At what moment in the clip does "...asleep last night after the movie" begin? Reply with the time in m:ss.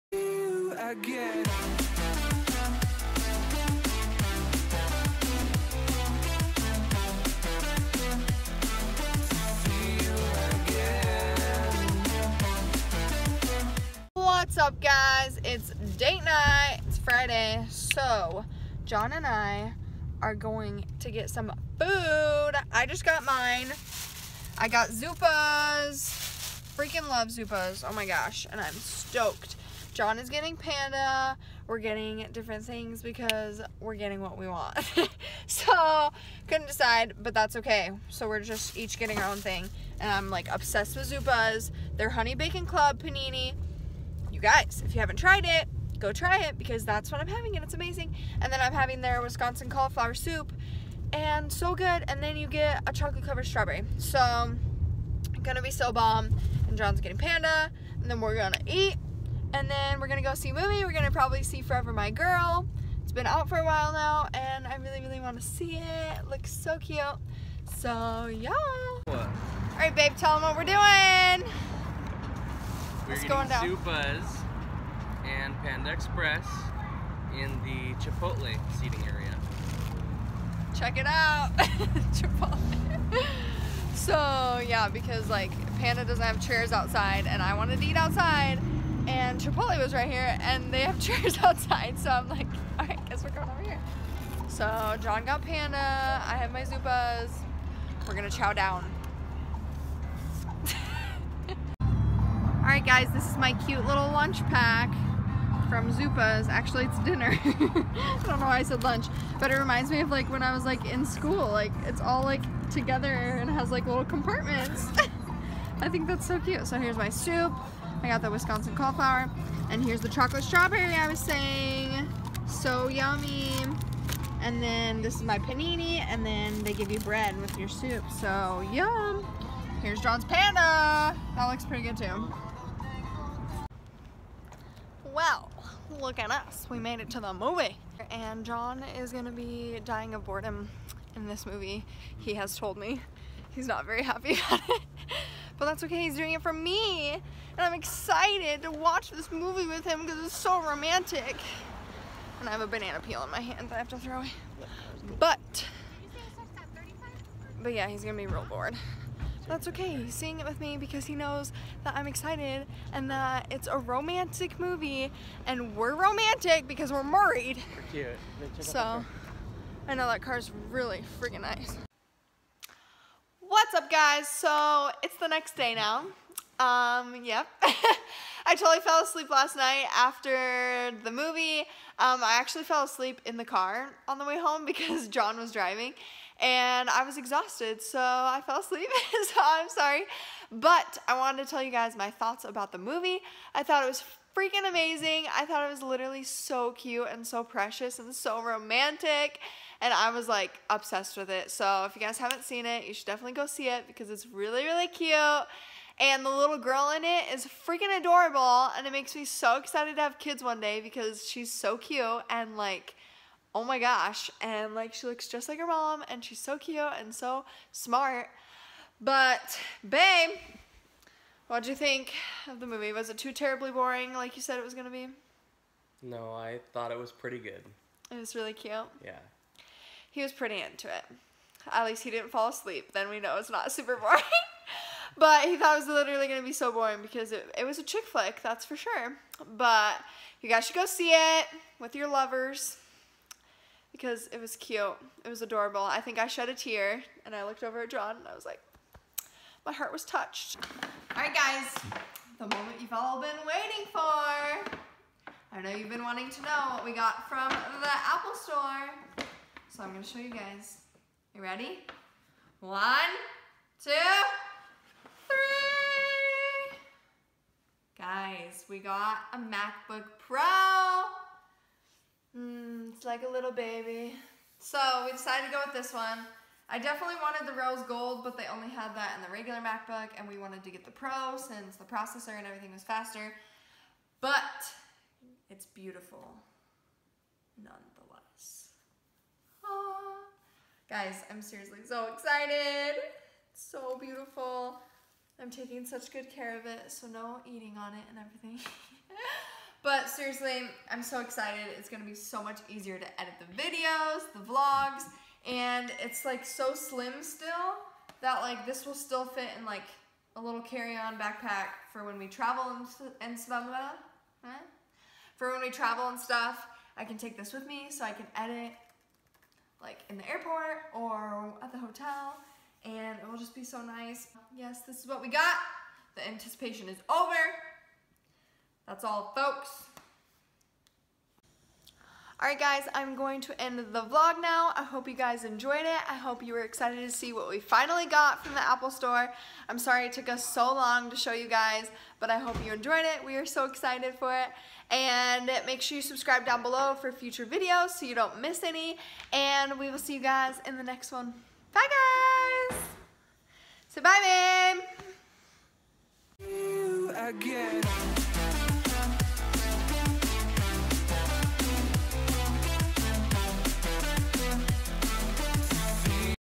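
2:59.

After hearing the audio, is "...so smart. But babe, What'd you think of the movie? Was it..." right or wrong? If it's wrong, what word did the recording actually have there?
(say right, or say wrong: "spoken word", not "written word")
right.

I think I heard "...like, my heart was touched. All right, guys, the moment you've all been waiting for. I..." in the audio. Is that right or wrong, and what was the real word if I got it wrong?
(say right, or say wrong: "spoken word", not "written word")
right.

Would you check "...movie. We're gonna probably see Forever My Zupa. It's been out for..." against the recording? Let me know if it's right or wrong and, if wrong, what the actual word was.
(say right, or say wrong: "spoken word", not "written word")
wrong: "Girl", not "Zupa".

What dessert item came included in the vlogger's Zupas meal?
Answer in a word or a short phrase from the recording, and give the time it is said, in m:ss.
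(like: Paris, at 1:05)
Chocolate covered strawberry, at 0:52.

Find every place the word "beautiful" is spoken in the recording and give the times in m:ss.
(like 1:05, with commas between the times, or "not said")
4:45, 4:53.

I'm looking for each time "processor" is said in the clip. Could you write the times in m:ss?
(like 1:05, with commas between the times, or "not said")
4:41.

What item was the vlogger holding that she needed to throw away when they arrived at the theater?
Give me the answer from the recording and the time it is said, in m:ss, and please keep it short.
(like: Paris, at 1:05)
Banana peel, at 2:32.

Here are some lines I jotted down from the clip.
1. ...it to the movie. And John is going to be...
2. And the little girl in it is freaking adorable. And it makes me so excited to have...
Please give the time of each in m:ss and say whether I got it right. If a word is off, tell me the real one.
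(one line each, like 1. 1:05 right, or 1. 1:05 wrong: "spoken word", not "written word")
1. 2:17 right
2. 3:25 right.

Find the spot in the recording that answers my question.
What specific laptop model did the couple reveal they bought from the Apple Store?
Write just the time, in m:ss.
4:29.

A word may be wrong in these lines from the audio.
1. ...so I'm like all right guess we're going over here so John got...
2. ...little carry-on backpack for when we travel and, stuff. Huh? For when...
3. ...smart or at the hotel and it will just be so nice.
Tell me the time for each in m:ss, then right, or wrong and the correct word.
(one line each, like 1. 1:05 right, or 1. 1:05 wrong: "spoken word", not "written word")
1. 1:31 right
2. 5:10 right
3. 5:20 wrong: "airport", not "smart".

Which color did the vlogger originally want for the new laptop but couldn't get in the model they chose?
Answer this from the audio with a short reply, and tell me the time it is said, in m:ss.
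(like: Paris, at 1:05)
Rose gold, at 4:37.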